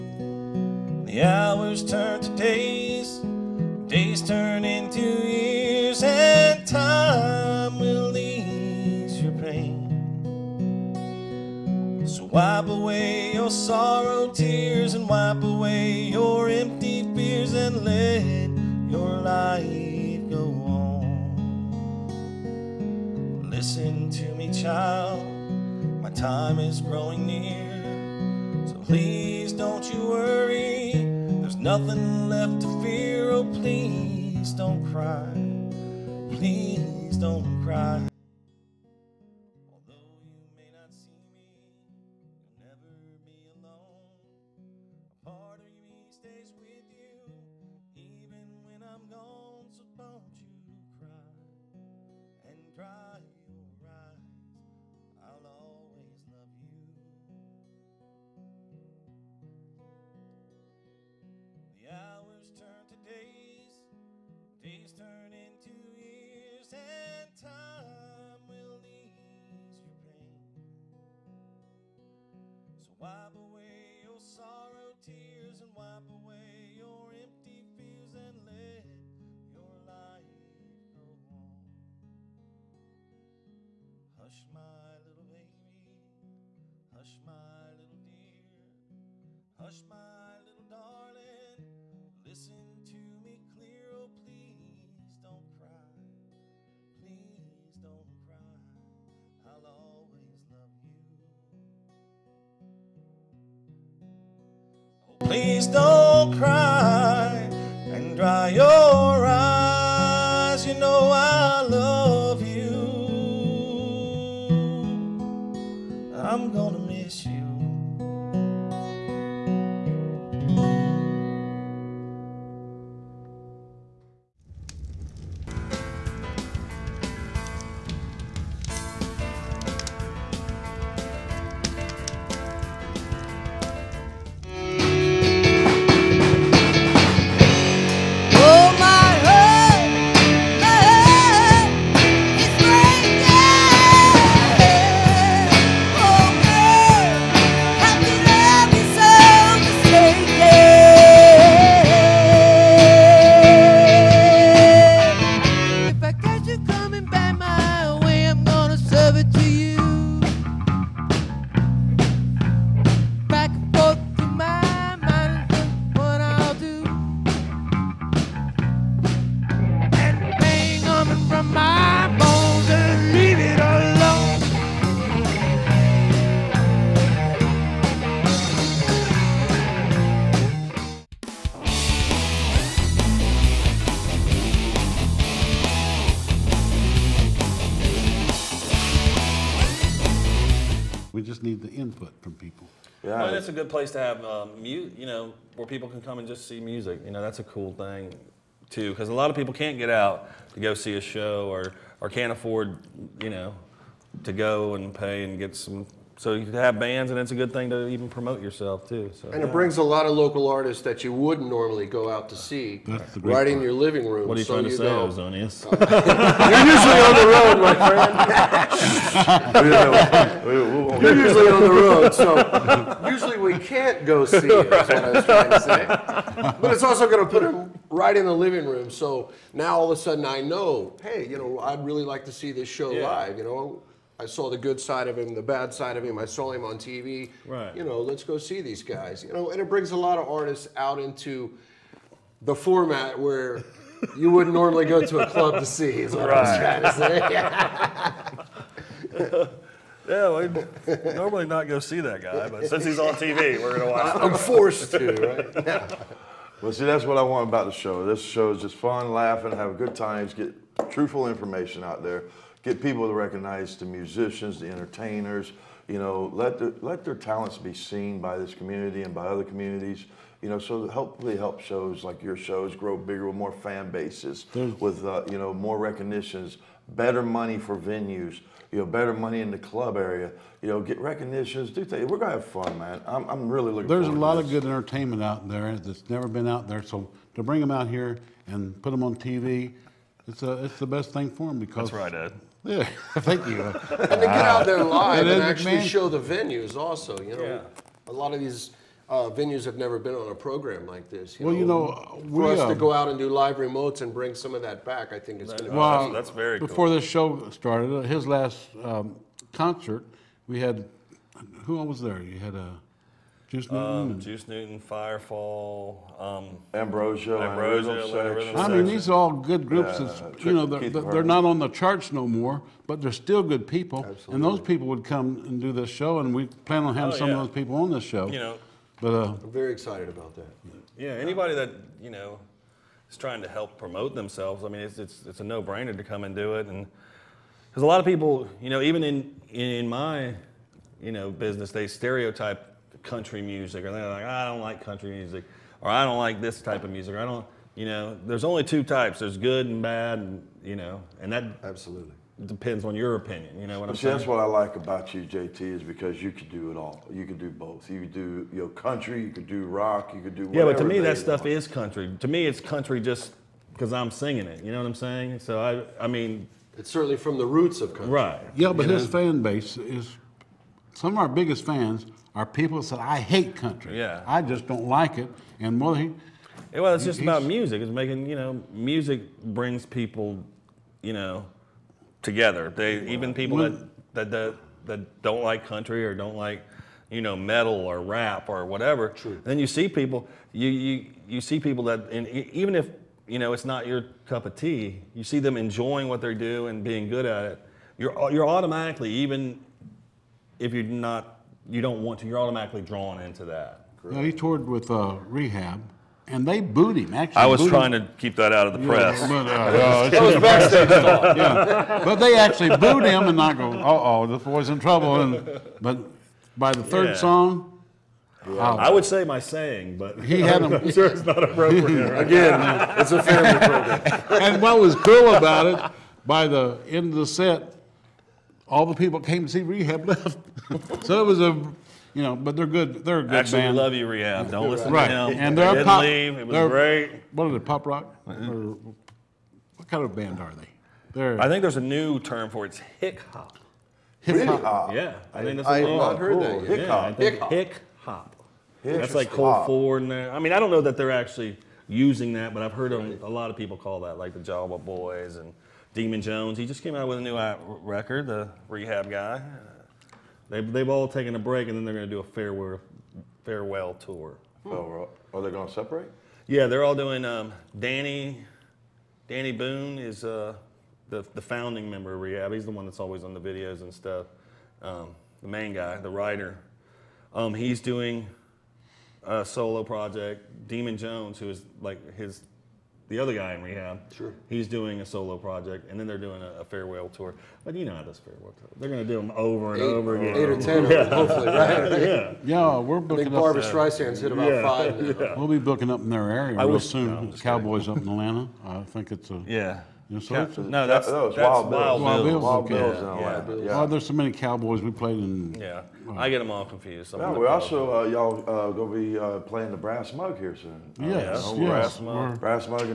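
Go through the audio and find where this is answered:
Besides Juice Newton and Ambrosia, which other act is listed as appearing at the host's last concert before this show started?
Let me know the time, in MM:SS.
05:14.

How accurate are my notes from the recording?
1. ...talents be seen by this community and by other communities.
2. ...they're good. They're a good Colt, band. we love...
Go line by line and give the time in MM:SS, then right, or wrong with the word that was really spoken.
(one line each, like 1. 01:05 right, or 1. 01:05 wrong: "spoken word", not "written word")
1. 04:27 right
2. 07:12 wrong: "Actually", not "Colt".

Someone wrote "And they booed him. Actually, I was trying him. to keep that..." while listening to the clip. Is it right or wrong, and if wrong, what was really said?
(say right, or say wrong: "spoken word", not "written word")
right.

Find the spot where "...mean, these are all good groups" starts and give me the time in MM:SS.
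05:18.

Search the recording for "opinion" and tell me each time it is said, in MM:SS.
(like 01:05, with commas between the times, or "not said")
05:53.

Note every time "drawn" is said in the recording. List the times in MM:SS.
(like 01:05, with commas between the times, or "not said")
06:42.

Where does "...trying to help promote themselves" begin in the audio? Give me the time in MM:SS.
05:33.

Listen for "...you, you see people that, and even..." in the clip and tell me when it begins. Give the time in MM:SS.
06:30.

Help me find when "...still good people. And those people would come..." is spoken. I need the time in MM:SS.
05:23.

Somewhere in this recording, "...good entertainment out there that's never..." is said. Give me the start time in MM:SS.
04:44.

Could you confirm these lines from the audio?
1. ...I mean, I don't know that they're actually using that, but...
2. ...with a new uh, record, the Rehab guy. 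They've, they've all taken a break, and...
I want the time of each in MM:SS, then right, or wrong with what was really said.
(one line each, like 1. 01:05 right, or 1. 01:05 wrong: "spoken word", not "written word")
1. 07:30 right
2. 07:37 right.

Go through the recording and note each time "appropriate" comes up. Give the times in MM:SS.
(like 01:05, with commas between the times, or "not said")
07:01.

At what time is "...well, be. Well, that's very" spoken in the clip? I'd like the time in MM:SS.
05:05.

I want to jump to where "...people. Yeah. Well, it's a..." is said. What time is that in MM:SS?
03:12.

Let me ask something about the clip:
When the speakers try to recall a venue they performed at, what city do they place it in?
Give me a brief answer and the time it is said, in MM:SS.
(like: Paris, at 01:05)
Atlanta, at 08:18.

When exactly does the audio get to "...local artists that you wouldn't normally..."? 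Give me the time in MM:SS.
03:30.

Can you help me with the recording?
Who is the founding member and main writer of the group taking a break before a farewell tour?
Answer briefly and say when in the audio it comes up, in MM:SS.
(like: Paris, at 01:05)
Danny Boone, at 07:49.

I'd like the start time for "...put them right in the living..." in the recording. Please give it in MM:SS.
03:47.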